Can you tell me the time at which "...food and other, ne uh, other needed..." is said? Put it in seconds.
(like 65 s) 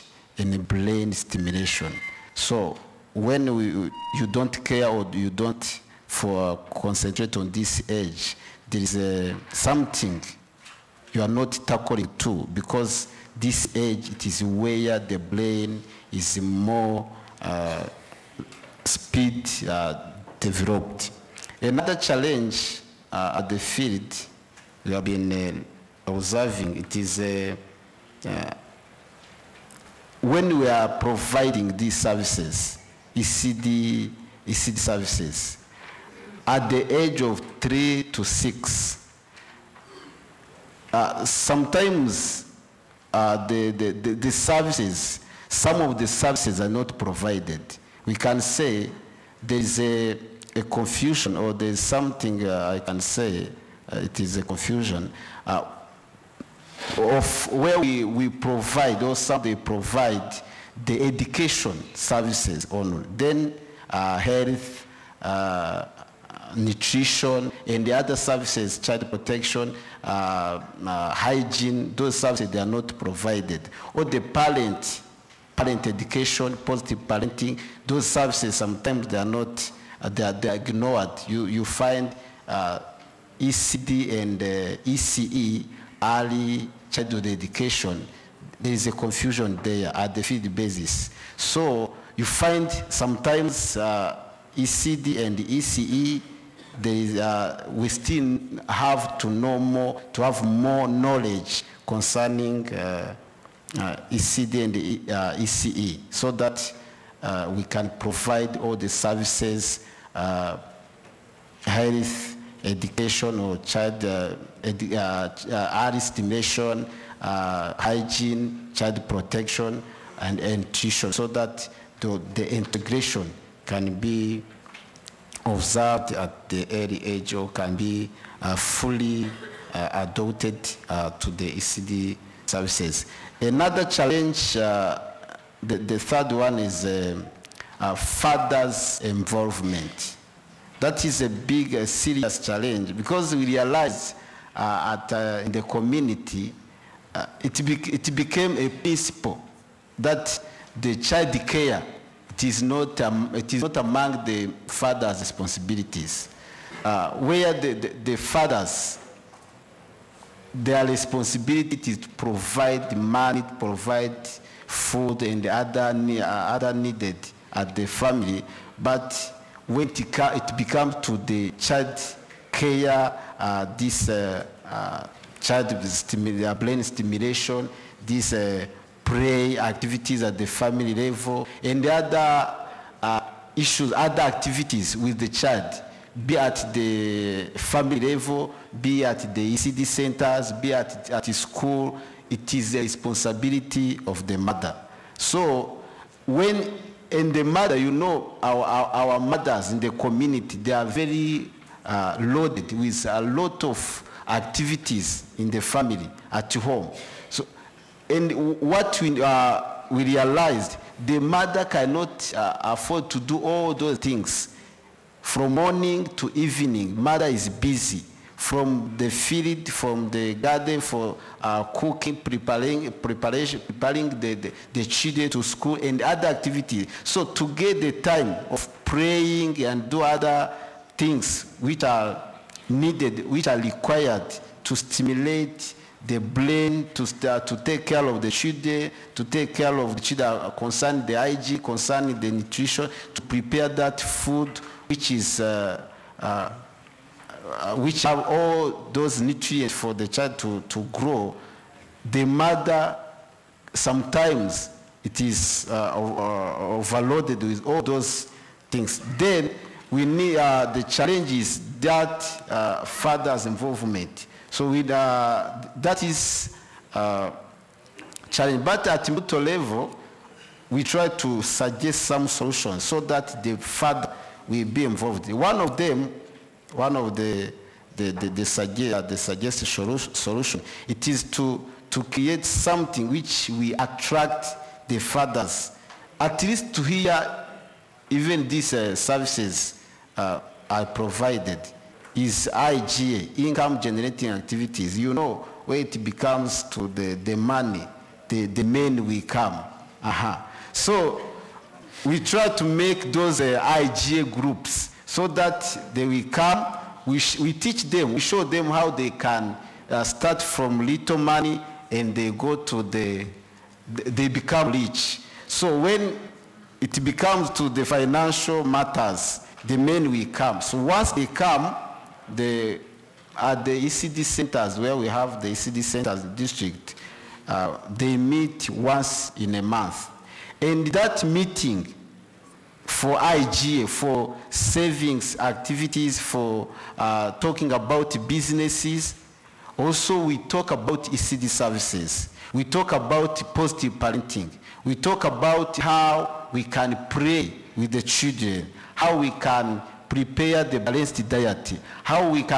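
164 s.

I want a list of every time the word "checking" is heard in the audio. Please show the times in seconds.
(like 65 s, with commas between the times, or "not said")
not said.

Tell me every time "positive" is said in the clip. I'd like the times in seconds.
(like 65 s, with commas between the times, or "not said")
76 s, 343 s.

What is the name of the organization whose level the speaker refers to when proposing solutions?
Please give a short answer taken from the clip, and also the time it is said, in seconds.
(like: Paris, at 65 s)
Imbuto, at 269 s.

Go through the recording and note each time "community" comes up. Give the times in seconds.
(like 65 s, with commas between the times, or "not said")
145 s, 199 s.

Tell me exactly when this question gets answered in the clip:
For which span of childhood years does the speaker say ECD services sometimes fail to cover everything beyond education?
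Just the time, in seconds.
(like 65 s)
37 s.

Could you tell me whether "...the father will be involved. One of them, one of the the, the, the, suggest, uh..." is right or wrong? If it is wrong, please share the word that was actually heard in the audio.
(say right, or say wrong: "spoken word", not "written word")
right.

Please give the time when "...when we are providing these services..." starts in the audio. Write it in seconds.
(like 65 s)
30 s.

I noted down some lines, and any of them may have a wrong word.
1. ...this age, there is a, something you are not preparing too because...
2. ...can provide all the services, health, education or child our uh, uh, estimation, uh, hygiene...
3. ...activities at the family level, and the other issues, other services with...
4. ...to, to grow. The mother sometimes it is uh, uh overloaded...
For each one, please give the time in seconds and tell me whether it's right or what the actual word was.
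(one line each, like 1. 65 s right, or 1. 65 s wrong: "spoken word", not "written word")
1. 7 s wrong: "tackling", not "preparing"
2. 107 s right
3. 179 s wrong: "activities", not "services"
4. 250 s right.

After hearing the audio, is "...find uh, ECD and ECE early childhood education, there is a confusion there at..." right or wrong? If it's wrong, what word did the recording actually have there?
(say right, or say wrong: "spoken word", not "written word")
right.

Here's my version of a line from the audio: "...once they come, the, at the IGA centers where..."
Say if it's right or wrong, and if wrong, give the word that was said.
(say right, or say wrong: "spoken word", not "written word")
wrong: "ECD", not "IGA".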